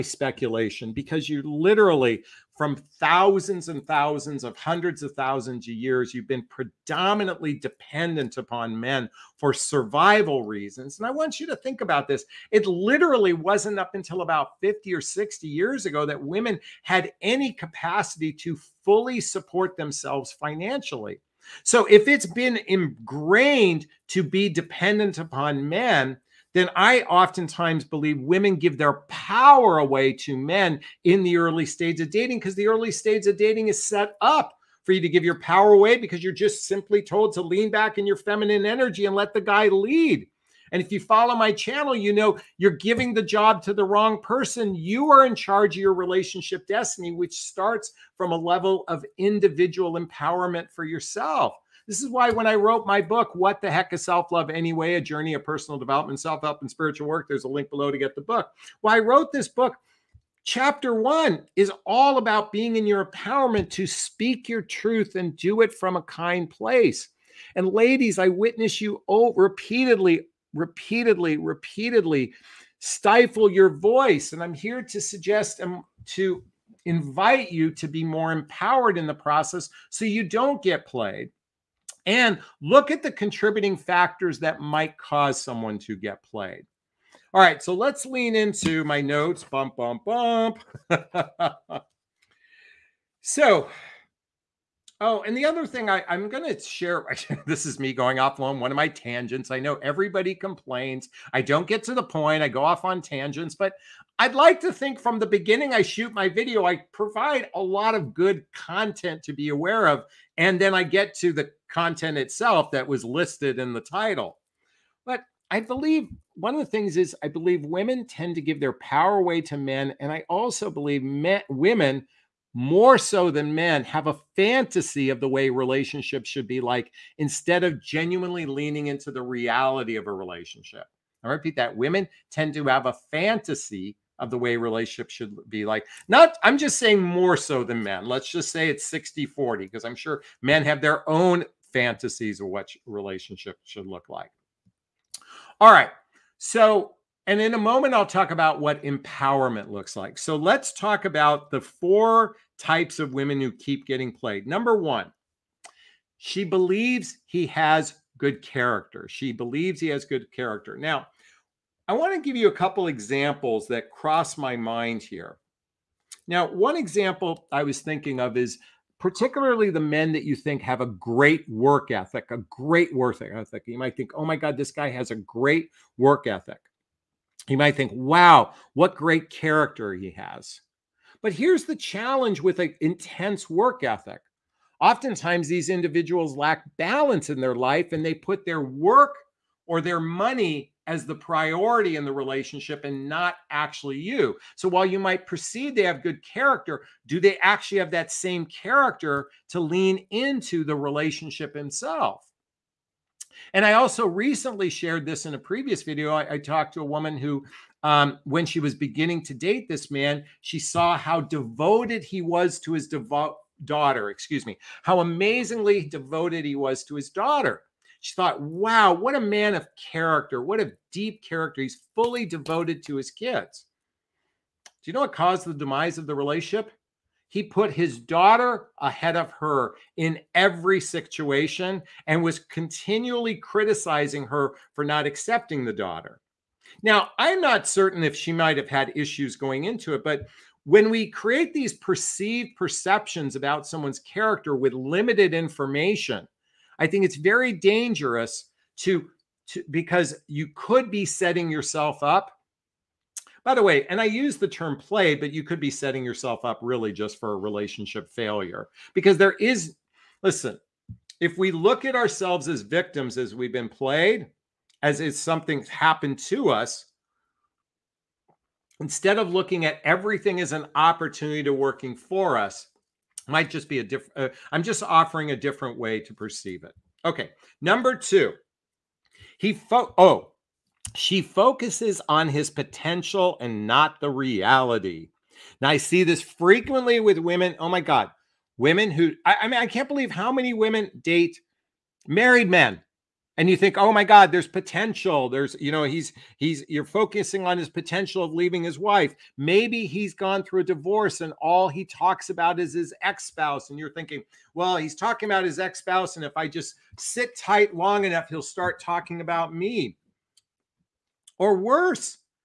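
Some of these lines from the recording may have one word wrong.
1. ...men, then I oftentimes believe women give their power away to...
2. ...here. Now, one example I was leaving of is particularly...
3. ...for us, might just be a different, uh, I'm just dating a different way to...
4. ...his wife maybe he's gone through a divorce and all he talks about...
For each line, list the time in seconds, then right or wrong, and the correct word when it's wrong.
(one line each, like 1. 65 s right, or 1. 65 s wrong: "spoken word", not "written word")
1. 25 s right
2. 165 s wrong: "thinking", not "leaving"
3. 271 s wrong: "offering", not "dating"
4. 298 s right.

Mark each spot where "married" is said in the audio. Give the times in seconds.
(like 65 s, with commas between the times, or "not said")
292 s.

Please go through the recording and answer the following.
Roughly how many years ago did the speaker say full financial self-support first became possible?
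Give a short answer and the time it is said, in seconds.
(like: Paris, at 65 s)
50 or 60 years, at 14 s.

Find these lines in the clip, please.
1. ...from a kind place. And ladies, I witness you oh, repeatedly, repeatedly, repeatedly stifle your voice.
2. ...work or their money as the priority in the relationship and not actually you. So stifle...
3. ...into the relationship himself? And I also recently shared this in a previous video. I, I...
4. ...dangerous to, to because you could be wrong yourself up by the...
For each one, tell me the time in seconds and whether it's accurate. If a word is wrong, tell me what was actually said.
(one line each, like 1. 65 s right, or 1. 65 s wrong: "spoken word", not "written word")
1. 65 s right
2. 188 s wrong: "while", not "stifle"
3. 200 s right
4. 247 s wrong: "setting", not "wrong".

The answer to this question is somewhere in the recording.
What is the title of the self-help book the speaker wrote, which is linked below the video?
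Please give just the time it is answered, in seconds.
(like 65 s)
53 s.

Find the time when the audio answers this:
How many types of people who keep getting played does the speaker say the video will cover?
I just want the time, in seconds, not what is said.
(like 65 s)
151 s.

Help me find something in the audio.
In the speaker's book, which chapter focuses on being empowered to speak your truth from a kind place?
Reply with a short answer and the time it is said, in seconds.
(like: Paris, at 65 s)
Chapter one, at 60 s.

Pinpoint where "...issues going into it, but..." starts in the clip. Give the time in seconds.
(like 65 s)
238 s.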